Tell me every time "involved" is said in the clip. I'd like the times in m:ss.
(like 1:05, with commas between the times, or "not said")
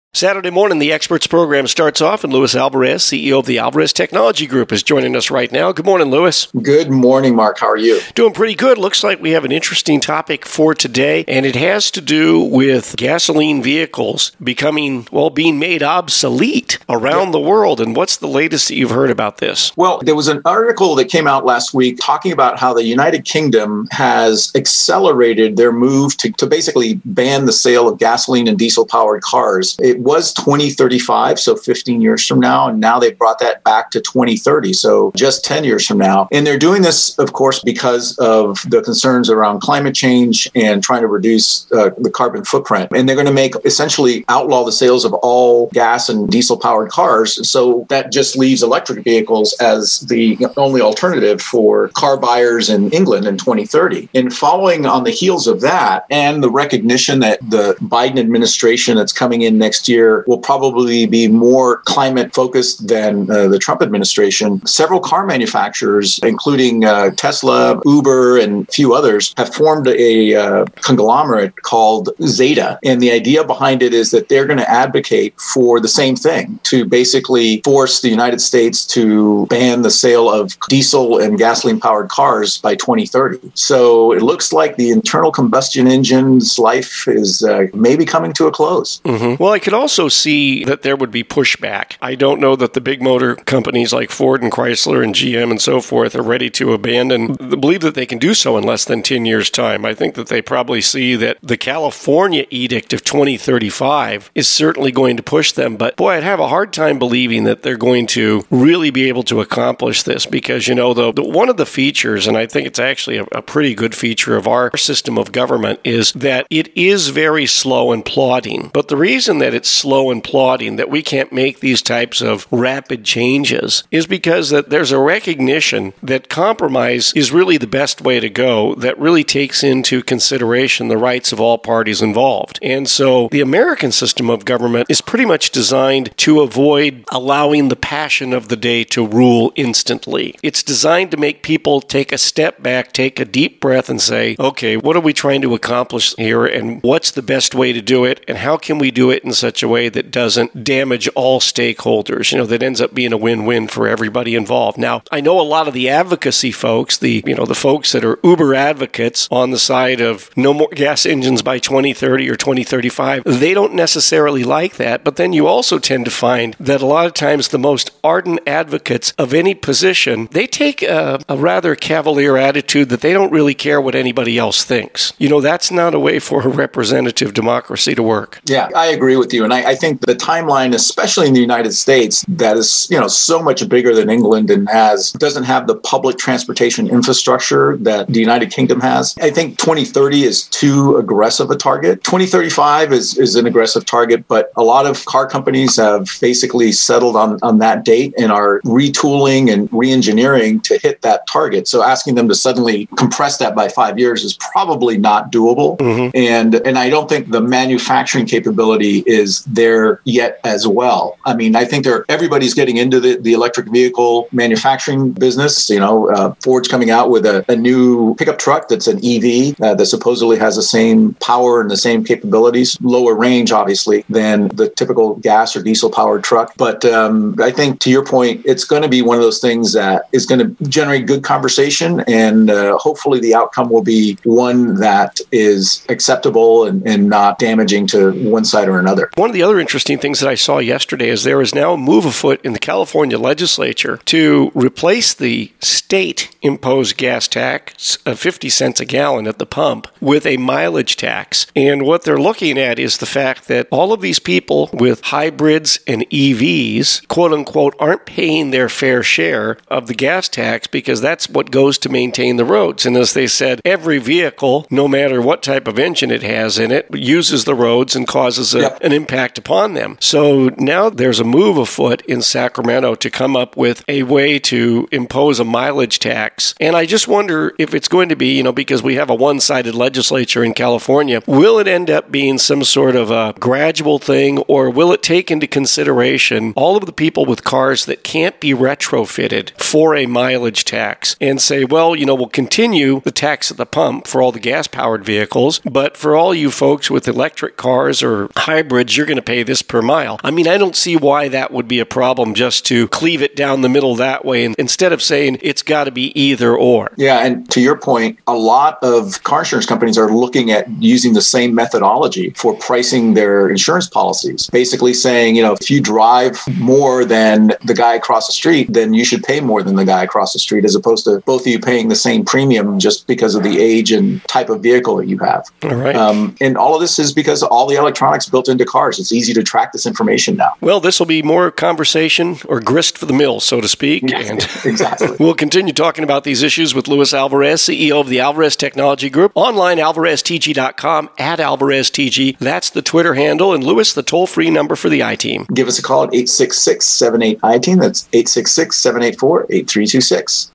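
2:12, 2:34.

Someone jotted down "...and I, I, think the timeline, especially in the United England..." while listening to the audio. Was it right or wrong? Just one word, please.
wrong.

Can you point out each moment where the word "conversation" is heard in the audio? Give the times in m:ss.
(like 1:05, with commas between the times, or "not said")
3:51, 5:31.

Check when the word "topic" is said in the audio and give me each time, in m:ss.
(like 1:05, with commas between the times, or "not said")
0:09.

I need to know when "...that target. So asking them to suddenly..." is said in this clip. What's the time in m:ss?
3:21.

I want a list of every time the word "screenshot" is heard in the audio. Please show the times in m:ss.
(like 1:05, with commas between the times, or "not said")
not said.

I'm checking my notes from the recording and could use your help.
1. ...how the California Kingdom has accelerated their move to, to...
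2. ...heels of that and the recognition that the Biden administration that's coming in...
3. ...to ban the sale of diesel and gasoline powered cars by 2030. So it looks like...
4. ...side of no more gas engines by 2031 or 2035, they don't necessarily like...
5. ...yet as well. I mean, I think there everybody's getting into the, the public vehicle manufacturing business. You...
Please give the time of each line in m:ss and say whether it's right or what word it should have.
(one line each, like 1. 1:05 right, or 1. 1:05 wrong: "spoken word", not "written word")
1. 0:22 wrong: "United", not "California"
2. 0:55 right
3. 1:18 right
4. 2:39 wrong: "2030", not "2031"
5. 3:30 wrong: "electric", not "public".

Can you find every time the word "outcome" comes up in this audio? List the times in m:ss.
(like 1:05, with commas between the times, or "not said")
3:53.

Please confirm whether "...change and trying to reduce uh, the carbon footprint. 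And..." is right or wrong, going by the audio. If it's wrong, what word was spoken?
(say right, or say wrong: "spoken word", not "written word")
right.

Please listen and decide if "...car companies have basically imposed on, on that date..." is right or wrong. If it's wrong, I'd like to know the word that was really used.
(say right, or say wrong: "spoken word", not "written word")
wrong: "settled", not "imposed".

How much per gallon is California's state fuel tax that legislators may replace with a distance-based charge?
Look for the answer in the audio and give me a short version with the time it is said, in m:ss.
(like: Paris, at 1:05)
50 cents, at 4:08.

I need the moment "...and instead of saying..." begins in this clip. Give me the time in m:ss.
5:04.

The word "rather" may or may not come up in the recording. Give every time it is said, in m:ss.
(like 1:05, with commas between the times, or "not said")
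2:51.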